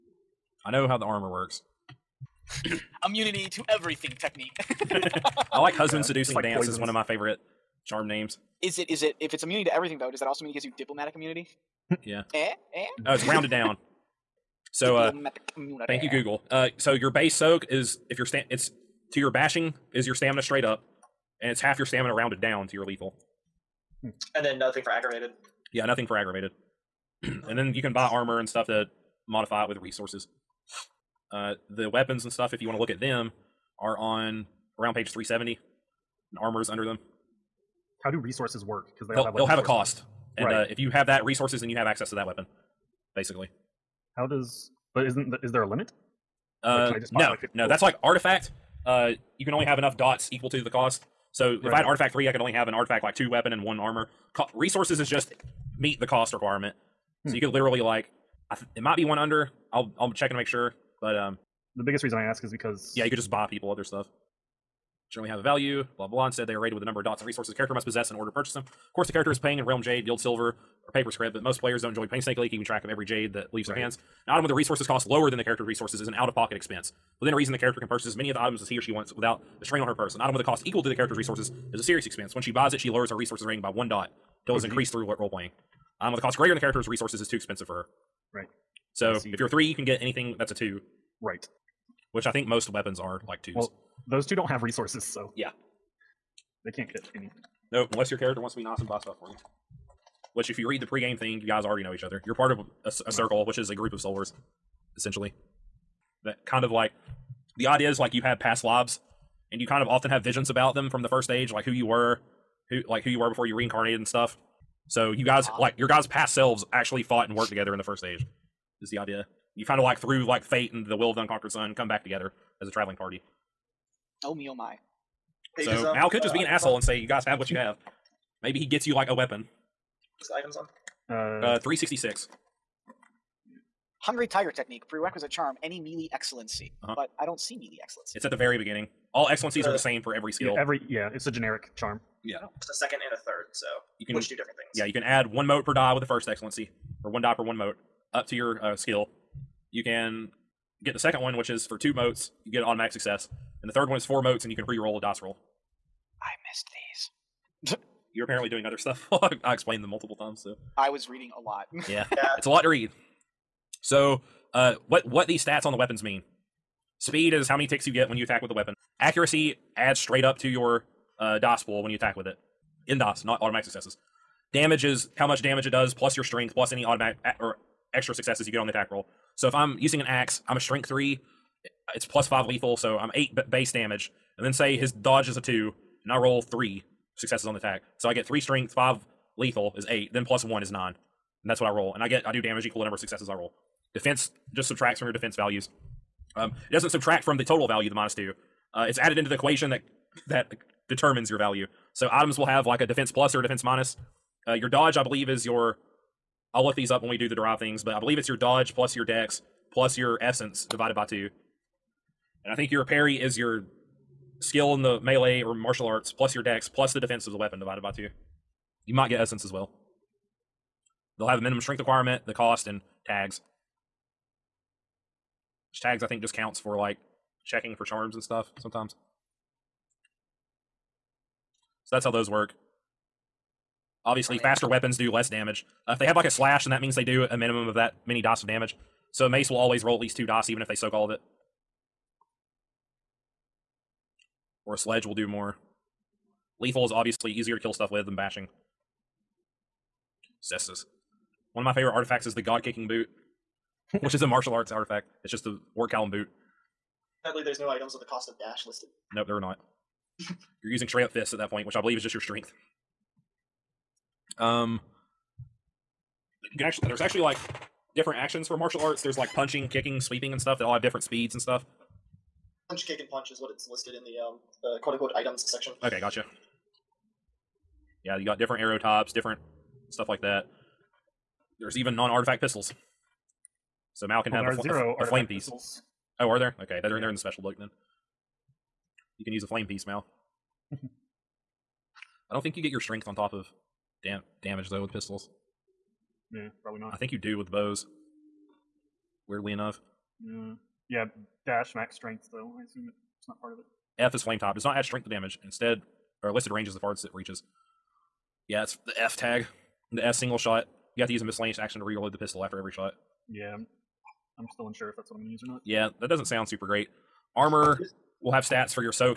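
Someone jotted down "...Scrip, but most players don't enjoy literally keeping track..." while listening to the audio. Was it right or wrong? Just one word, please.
wrong.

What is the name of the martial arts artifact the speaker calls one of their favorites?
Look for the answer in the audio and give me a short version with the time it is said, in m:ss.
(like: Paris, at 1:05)
God Kicking Boot, at 4:12.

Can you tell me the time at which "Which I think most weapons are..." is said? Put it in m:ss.
1:32.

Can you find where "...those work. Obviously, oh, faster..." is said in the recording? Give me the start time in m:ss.
3:52.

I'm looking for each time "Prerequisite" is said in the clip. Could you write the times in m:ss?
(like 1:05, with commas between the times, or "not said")
2:14.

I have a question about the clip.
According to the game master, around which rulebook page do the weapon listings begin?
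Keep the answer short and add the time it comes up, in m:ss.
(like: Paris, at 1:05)
370, at 0:34.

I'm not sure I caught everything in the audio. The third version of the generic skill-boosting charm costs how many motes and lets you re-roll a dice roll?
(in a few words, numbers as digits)
4.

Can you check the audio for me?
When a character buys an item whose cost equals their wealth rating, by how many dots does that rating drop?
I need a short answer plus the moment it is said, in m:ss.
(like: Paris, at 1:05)
1, at 1:23.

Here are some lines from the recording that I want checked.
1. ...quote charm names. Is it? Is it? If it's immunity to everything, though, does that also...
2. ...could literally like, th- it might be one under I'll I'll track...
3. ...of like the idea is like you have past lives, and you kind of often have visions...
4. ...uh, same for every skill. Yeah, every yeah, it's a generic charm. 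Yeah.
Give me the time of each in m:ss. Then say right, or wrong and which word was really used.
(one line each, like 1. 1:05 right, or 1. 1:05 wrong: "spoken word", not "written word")
1. 0:07 wrong: "favorite", not "quote"
2. 0:57 wrong: "check", not "track"
3. 1:46 right
4. 2:19 right.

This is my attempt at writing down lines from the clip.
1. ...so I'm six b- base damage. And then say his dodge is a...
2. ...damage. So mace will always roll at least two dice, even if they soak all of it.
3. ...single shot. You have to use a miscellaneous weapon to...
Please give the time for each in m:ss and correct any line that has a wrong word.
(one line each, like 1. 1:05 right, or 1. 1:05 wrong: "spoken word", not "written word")
1. 3:02 wrong: "eight", not "six"
2. 3:58 right
3. 5:10 wrong: "action", not "weapon".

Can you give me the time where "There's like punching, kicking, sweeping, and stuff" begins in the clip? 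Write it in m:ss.
4:29.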